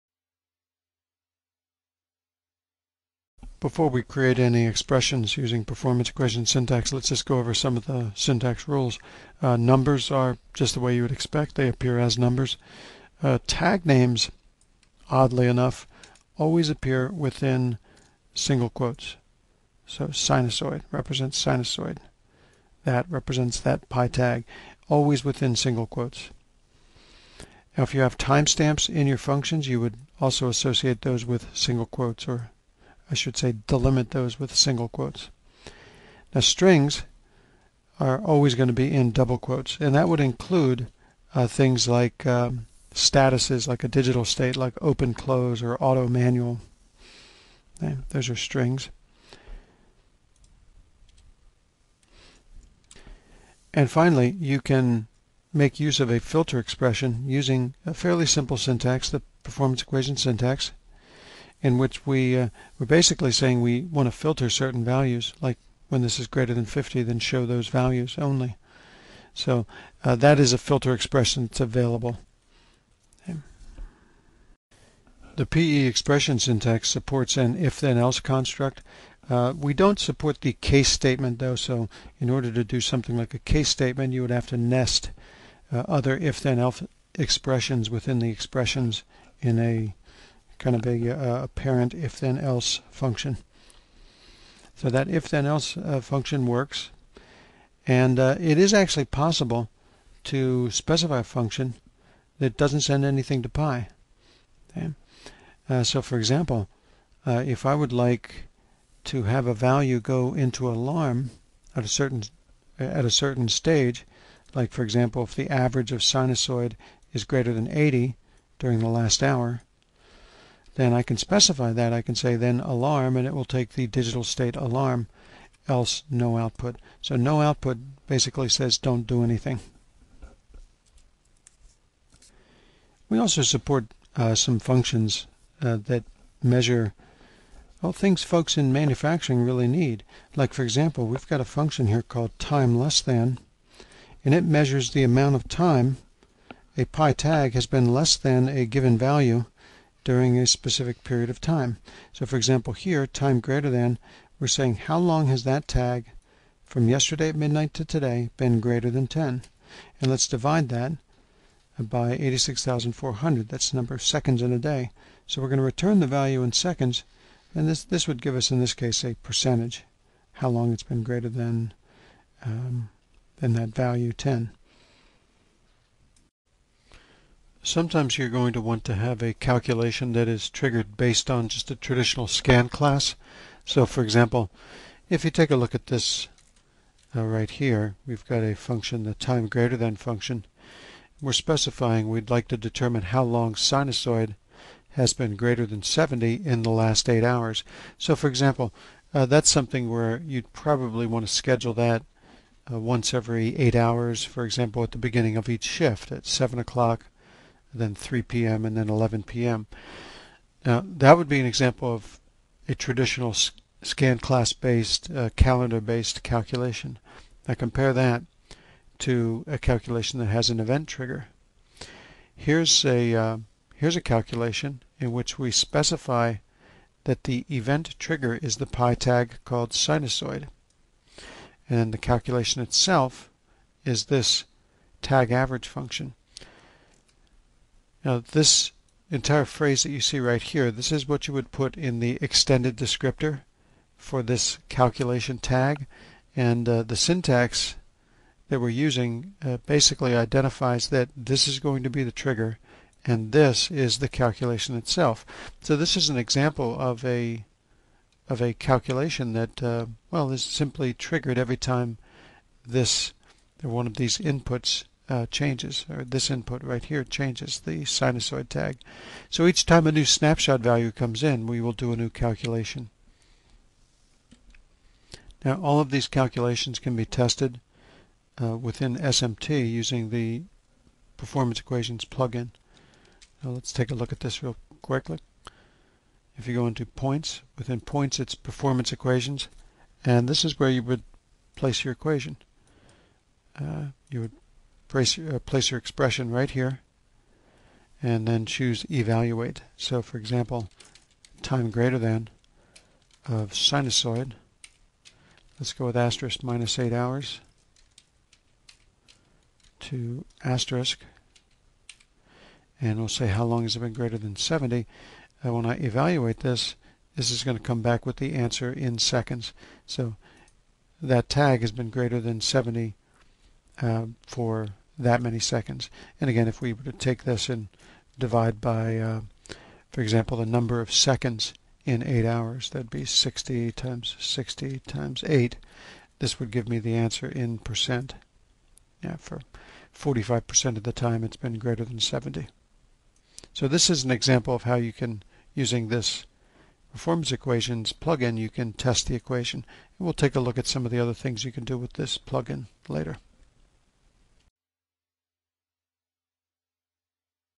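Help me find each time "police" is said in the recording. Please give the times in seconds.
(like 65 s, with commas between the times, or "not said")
not said.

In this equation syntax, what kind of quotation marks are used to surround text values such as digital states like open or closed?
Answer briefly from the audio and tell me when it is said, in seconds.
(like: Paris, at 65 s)
double quotes, at 39 s.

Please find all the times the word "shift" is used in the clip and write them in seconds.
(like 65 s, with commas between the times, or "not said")
205 s.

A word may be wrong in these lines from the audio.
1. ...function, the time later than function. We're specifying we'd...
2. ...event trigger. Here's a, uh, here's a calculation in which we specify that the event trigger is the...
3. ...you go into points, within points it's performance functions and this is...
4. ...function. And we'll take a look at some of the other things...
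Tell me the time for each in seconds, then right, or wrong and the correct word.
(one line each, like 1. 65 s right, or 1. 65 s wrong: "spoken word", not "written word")
1. 188 s wrong: "greater", not "later"
2. 220 s right
3. 286 s wrong: "equations", not "functions"
4. 349 s wrong: "equation", not "function".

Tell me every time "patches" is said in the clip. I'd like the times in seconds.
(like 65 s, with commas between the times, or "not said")
not said.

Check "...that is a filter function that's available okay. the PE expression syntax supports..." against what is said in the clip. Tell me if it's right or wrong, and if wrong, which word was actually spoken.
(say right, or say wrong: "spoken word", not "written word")
wrong: "expression", not "function".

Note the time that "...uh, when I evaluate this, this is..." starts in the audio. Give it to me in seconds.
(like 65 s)
315 s.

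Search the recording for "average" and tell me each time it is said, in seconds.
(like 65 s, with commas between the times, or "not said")
115 s, 235 s.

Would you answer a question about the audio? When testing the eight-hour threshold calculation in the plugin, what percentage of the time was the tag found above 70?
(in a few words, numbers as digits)
45%.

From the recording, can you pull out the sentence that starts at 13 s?
Uh, tag names, oddly enough, always appear within single quotes.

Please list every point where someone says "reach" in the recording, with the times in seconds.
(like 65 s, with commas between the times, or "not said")
not said.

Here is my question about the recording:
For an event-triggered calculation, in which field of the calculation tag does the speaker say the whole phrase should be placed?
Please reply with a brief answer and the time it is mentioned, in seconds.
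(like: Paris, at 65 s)
extended descriptor, at 242 s.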